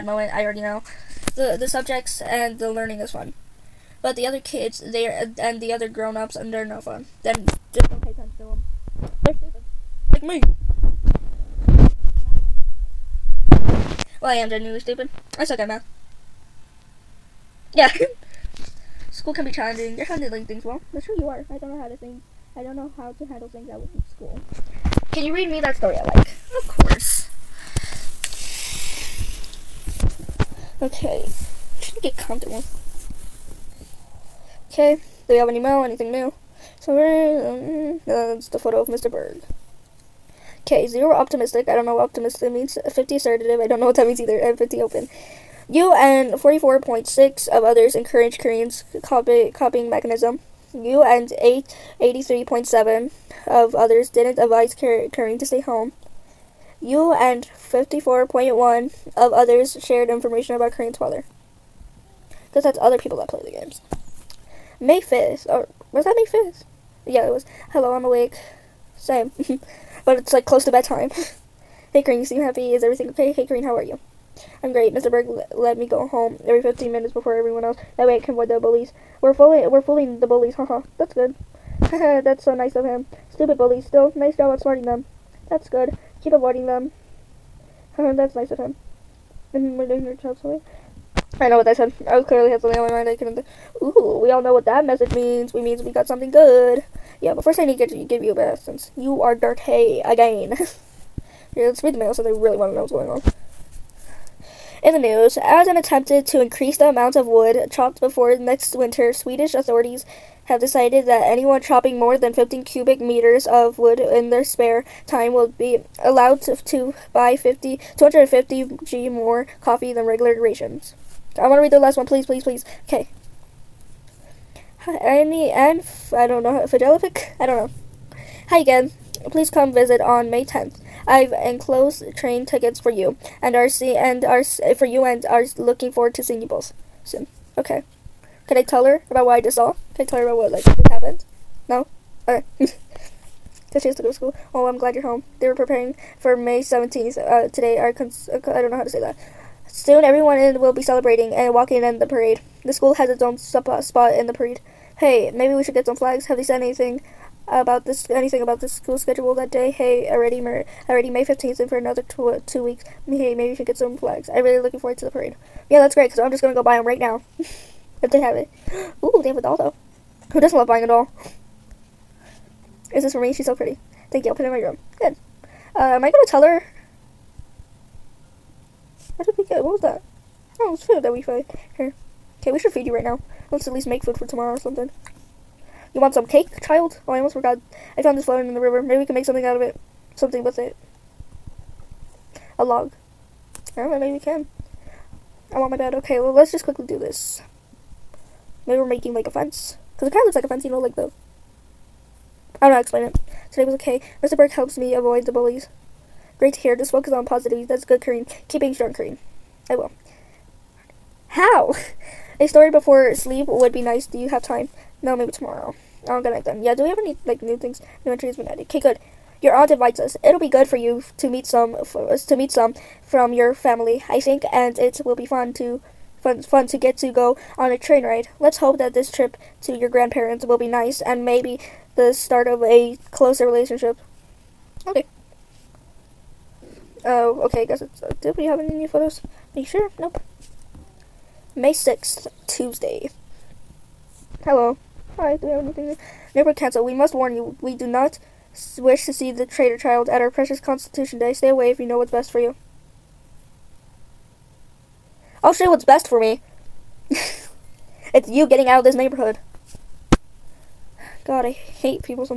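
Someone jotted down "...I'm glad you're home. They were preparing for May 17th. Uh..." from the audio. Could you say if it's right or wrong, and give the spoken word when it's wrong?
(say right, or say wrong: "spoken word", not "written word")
right.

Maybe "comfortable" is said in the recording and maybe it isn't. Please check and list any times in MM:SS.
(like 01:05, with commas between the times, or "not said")
00:32.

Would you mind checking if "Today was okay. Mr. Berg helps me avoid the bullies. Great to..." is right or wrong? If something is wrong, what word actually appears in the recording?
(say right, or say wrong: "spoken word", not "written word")
right.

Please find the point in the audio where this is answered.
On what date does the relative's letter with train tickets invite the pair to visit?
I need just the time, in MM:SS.
02:10.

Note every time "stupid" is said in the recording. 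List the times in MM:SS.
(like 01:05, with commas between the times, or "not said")
00:09, 00:14, 01:23.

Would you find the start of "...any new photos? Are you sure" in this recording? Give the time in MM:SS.
03:58.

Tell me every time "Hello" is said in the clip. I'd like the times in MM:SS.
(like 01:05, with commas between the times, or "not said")
01:07, 04:04.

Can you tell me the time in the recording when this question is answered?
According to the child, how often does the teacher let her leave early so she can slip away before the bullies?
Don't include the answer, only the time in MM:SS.
01:16.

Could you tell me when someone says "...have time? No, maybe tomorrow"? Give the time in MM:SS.
03:34.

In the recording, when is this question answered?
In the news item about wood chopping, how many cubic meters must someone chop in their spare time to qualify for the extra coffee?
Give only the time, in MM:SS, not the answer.
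01:52.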